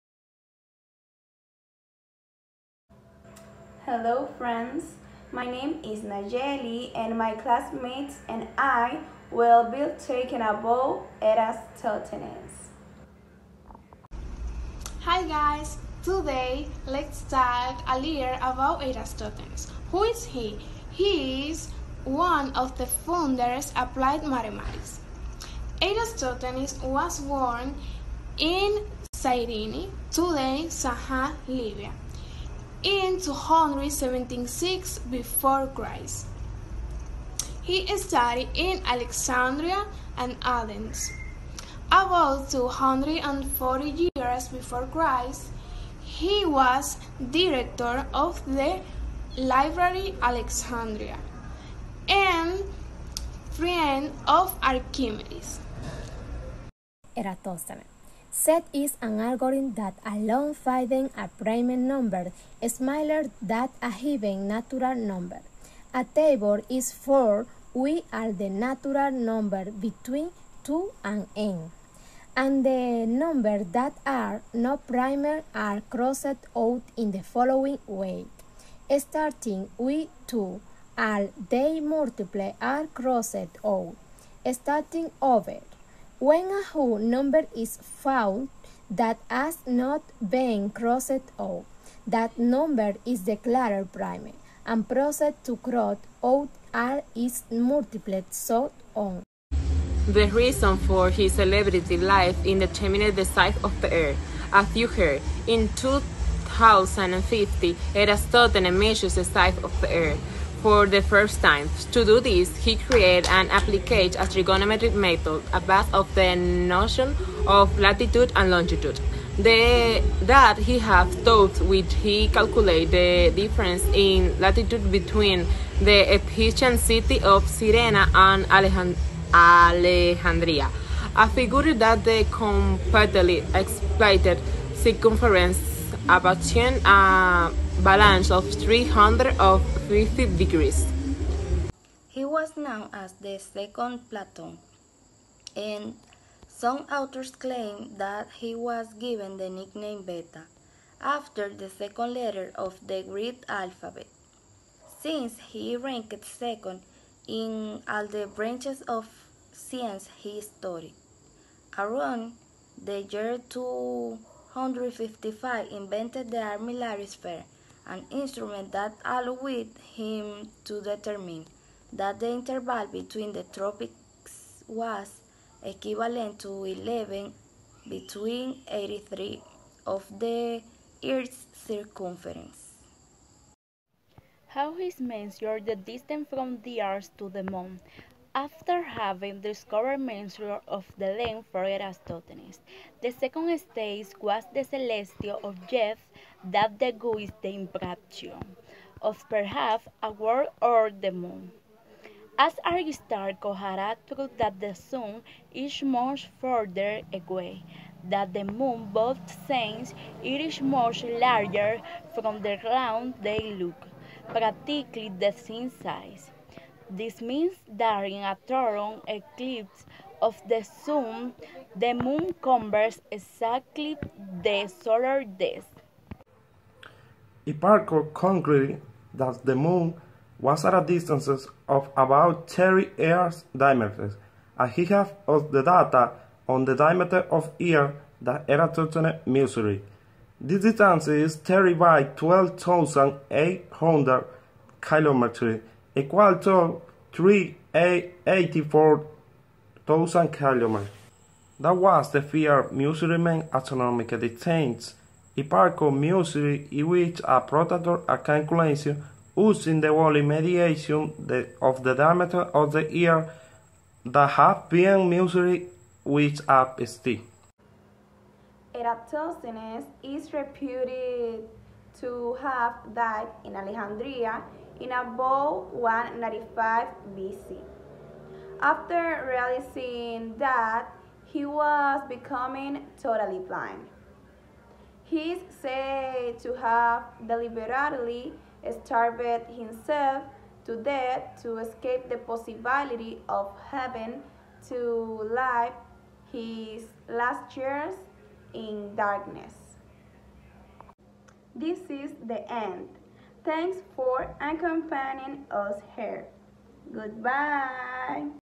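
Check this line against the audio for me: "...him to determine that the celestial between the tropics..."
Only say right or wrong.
wrong.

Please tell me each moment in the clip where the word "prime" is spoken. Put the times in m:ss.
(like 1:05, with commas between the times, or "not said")
1:01, 1:14, 1:33.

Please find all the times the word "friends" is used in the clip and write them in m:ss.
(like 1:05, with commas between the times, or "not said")
0:04, 0:53.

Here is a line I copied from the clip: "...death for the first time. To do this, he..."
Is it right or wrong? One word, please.
wrong.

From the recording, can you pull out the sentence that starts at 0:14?
Hi guys, today let's talk a little about Eratosthenes.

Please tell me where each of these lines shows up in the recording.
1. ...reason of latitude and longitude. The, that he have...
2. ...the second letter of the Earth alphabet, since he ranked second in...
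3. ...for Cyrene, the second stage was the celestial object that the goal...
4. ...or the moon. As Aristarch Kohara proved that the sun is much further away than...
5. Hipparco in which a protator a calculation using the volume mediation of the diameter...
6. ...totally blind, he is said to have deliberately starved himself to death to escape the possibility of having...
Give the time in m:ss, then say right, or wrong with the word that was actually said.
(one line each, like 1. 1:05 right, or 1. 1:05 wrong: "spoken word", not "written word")
1. 1:56 wrong: "notion", not "reason"
2. 2:31 wrong: "Greek", not "Earth"
3. 3:11 wrong: "Eratosthenes", not "Cyrene"
4. 3:20 right
5. 4:15 right
6. 4:43 right.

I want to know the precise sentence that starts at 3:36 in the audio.
This means that during a total eclipse of the sun, the moon covers exactly the solar disk.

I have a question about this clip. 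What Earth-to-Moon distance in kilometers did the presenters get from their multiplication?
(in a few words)
384,000 kilometers.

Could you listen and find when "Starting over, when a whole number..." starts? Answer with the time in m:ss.
1:24.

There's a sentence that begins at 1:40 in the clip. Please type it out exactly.
The reason for his celebrity life determining the size of the earth.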